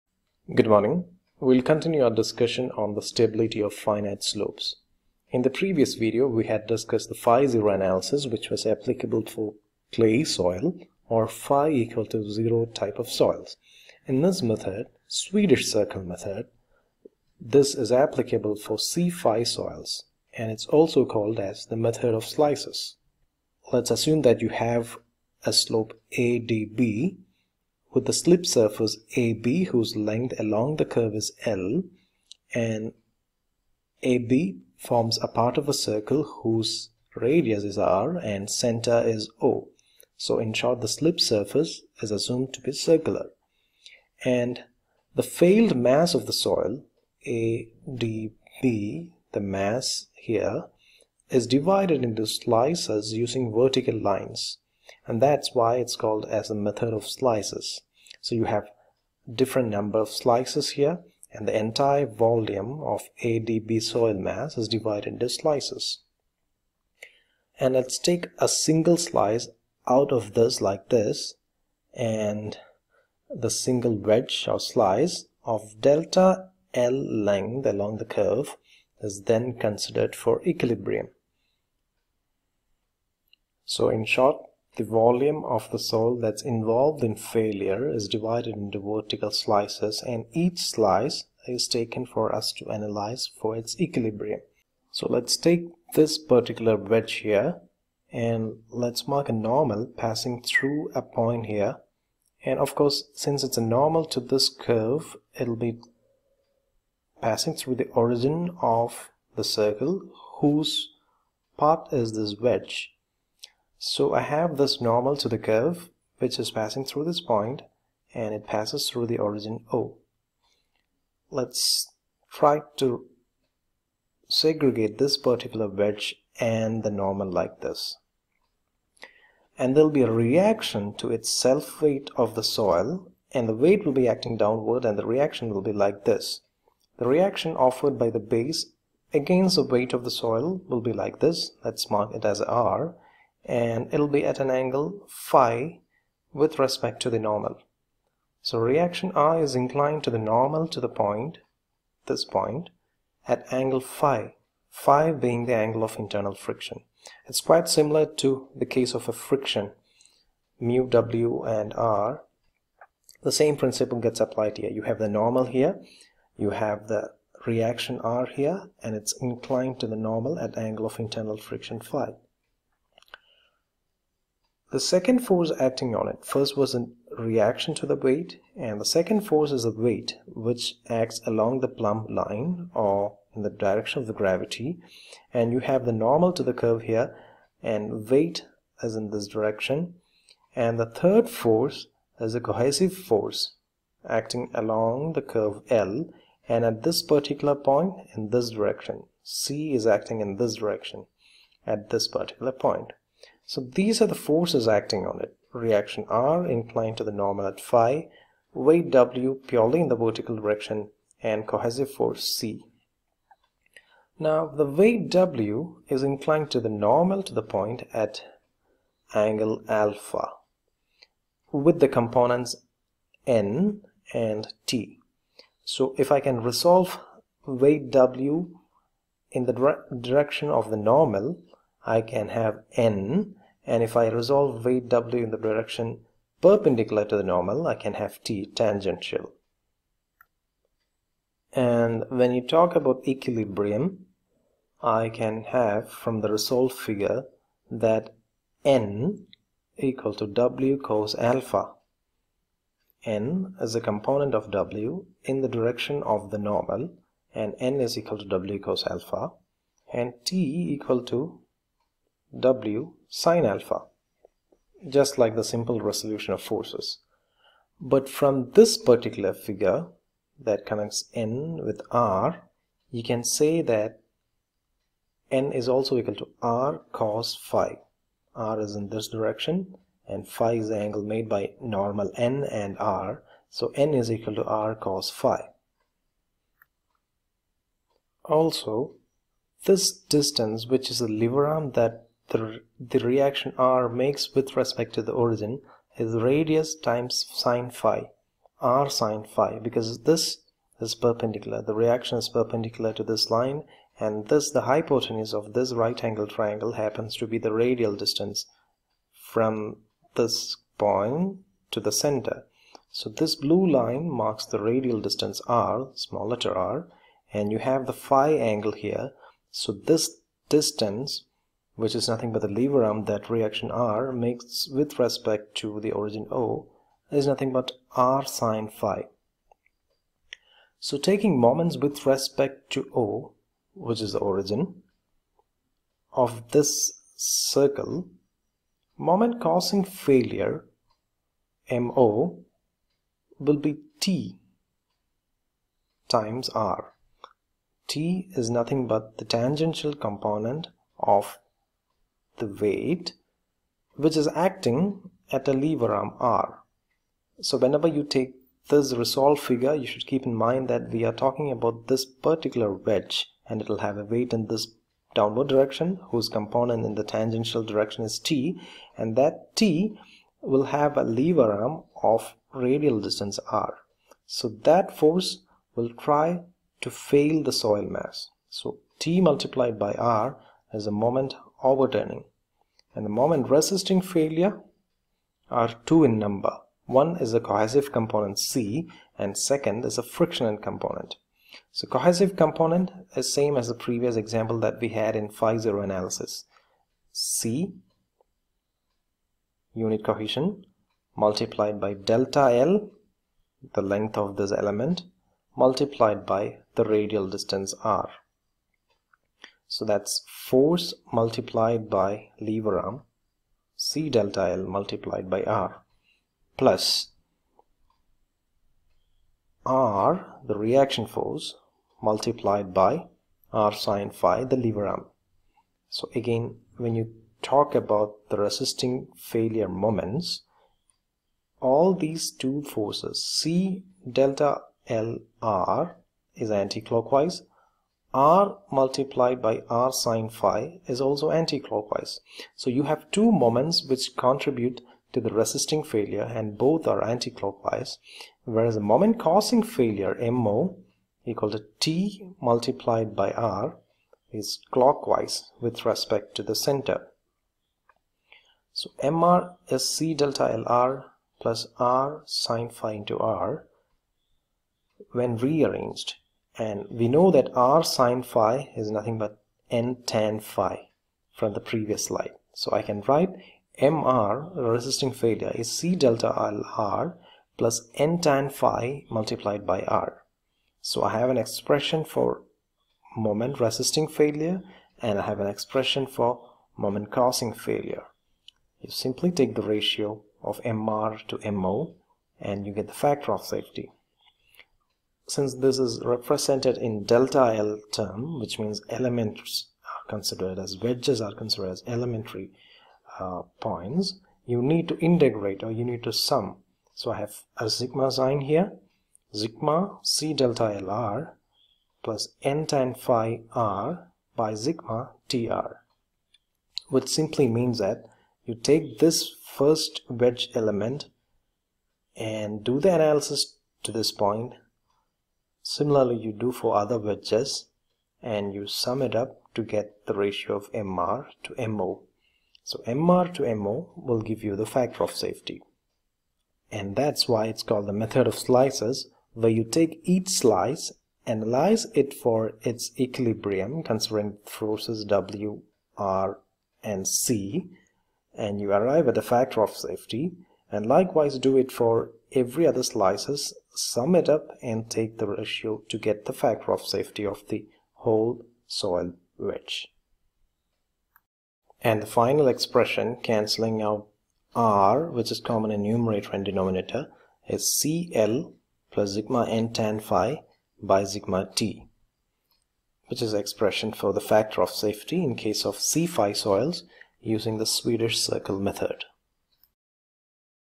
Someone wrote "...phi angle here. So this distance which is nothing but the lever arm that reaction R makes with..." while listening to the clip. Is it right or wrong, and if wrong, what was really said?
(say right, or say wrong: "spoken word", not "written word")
right.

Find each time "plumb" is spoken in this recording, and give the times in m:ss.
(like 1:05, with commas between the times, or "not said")
3:01.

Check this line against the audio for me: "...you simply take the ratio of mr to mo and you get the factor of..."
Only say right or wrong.
right.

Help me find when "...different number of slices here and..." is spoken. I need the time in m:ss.
0:59.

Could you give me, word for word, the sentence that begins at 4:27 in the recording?
But from this particular figure that connects N with R, you can say that N is also equal to R cos phi.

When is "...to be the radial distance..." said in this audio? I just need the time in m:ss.
5:07.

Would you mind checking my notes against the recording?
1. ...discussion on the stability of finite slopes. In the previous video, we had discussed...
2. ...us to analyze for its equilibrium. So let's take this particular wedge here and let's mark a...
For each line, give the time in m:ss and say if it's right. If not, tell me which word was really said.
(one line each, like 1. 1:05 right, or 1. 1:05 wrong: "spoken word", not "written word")
1. 0:02 right
2. 1:32 right.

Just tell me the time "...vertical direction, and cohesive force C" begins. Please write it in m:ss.
3:29.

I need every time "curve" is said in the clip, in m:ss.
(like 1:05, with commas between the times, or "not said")
0:30, 1:18, 1:44, 1:55, 3:06, 3:15.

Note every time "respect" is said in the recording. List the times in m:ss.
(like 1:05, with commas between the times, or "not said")
2:26, 4:54, 5:24, 5:32, 7:35.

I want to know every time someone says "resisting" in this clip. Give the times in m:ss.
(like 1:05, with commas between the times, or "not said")
6:23, 7:08, 7:25, 7:54, 8:03.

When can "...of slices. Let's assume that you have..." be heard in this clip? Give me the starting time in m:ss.
0:22.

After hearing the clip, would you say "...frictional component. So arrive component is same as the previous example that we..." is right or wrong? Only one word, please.
wrong.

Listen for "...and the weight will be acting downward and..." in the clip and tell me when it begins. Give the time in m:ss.
2:13.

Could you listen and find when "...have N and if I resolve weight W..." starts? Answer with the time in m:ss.
3:52.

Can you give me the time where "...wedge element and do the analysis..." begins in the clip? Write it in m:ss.
8:40.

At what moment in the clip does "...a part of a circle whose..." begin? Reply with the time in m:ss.
0:35.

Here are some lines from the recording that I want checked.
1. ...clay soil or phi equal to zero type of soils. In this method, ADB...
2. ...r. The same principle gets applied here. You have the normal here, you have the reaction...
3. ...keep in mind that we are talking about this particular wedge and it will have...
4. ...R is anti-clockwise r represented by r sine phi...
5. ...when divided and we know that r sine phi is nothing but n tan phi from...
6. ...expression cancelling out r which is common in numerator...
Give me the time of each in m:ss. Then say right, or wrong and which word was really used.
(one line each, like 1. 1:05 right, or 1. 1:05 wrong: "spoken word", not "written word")
1. 0:09 wrong: "Swedish", not "ADB"
2. 2:41 right
3. 6:00 right
4. 7:15 wrong: "multiplied", not "represented"
5. 7:45 wrong: "rearranged", not "divided"
6. 9:22 right.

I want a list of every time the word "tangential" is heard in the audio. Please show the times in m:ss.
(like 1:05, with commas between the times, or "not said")
3:58, 5:49, 6:07.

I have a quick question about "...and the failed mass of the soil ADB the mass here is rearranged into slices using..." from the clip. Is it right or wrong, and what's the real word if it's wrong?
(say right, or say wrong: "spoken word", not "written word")
wrong: "divided", not "rearranged".